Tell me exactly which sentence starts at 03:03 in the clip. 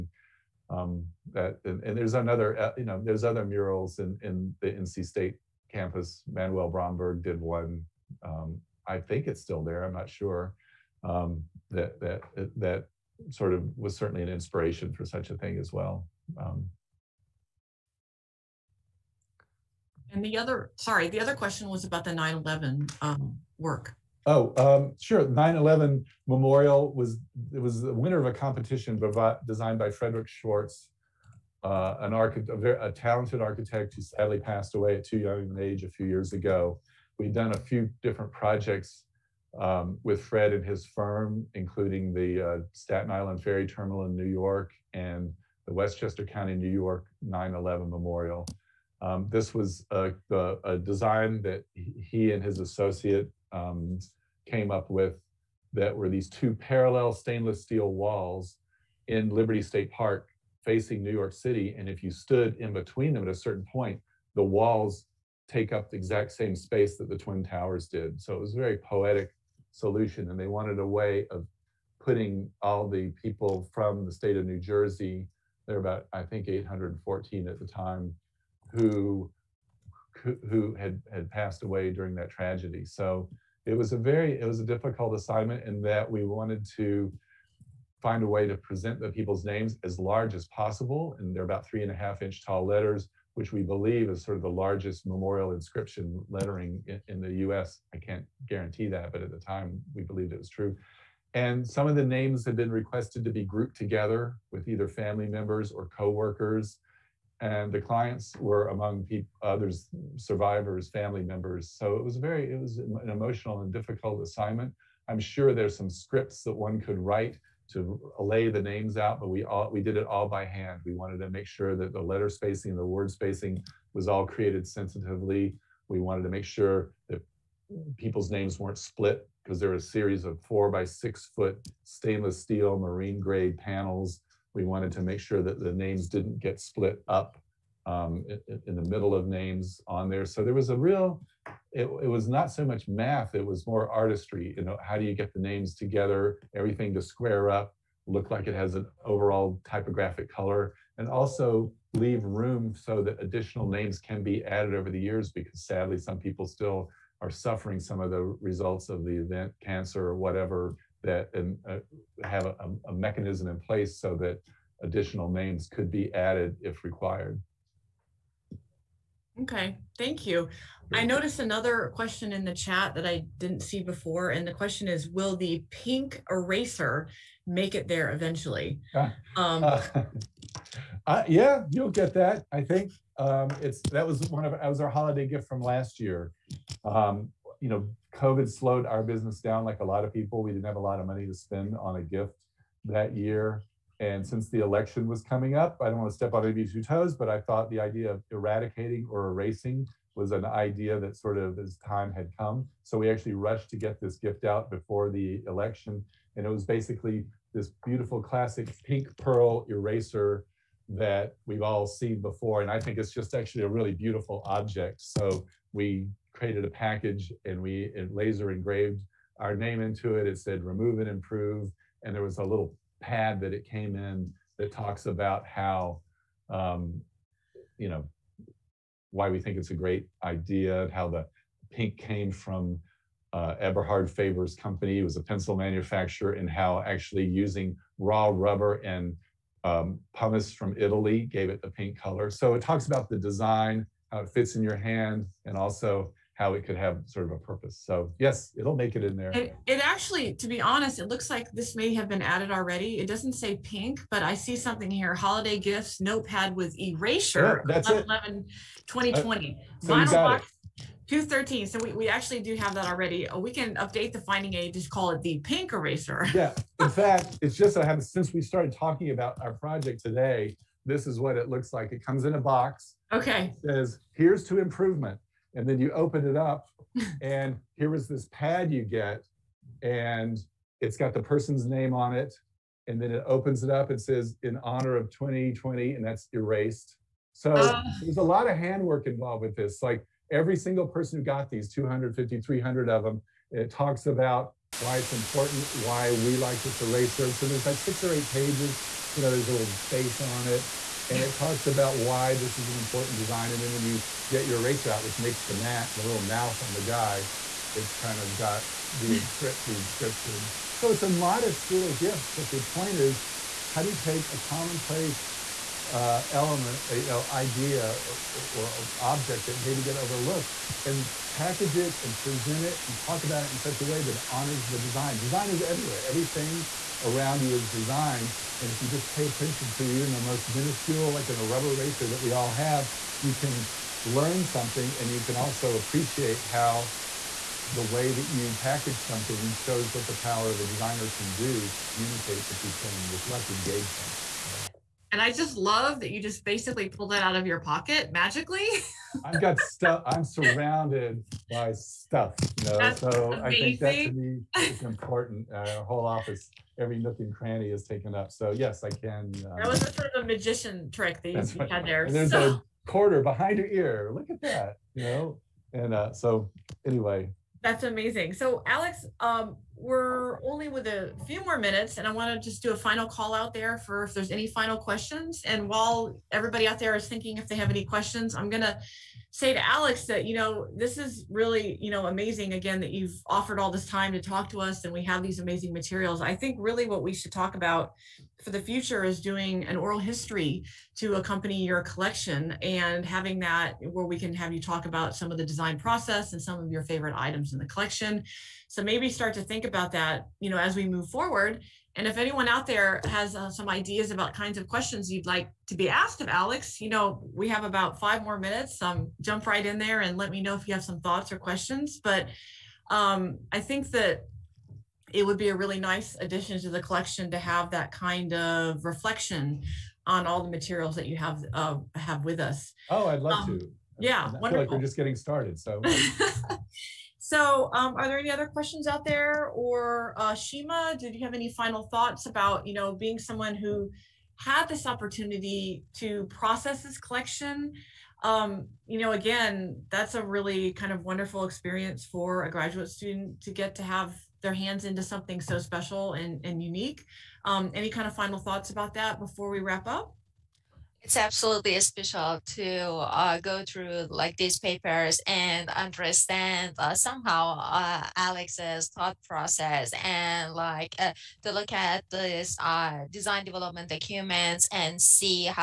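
Um, it's That was one of, that was our holiday gift from last year.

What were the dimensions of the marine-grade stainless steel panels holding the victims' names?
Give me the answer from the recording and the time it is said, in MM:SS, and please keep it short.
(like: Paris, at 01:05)
4 by 6 feet, at 02:10.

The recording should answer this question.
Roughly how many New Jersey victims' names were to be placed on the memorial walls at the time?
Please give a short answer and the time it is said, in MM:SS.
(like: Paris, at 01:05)
814, at 01:16.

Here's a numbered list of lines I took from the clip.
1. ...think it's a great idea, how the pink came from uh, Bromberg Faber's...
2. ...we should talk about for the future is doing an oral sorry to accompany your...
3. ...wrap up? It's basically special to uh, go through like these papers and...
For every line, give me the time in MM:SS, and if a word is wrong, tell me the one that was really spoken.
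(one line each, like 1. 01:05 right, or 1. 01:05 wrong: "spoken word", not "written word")
1. 03:49 wrong: "Eberhard", not "Bromberg"
2. 06:27 wrong: "history", not "sorry"
3. 07:29 wrong: "absolutely", not "basically".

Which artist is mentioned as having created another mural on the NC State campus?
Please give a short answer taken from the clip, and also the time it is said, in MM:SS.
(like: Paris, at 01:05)
Manuel Bromberg, at 00:06.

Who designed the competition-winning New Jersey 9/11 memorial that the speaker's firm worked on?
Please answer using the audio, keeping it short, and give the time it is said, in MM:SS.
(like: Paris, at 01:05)
Frederick Schwartz, at 00:29.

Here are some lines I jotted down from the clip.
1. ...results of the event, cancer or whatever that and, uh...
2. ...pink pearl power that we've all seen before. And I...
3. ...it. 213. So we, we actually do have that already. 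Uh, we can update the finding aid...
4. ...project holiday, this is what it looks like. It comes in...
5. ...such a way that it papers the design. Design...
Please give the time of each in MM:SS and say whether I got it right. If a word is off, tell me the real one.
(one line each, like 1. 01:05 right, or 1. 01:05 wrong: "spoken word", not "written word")
1. 02:38 right
2. 03:28 wrong: "eraser", not "power"
3. 04:20 right
4. 04:29 wrong: "today", not "holiday"
5. 05:23 wrong: "honors", not "papers".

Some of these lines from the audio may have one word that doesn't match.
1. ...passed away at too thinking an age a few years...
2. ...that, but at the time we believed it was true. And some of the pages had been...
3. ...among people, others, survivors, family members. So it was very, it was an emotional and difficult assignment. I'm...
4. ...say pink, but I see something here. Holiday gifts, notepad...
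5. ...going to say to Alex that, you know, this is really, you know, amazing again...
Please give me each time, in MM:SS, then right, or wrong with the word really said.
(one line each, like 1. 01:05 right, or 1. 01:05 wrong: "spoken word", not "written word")
1. 00:34 wrong: "young", not "thinking"
2. 01:38 wrong: "names", not "pages"
3. 01:48 right
4. 04:13 right
5. 06:18 right.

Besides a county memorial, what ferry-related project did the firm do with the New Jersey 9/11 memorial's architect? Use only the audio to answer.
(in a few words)
Staten Island Ferry Terminal.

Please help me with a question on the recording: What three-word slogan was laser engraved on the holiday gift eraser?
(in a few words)
remove and improve.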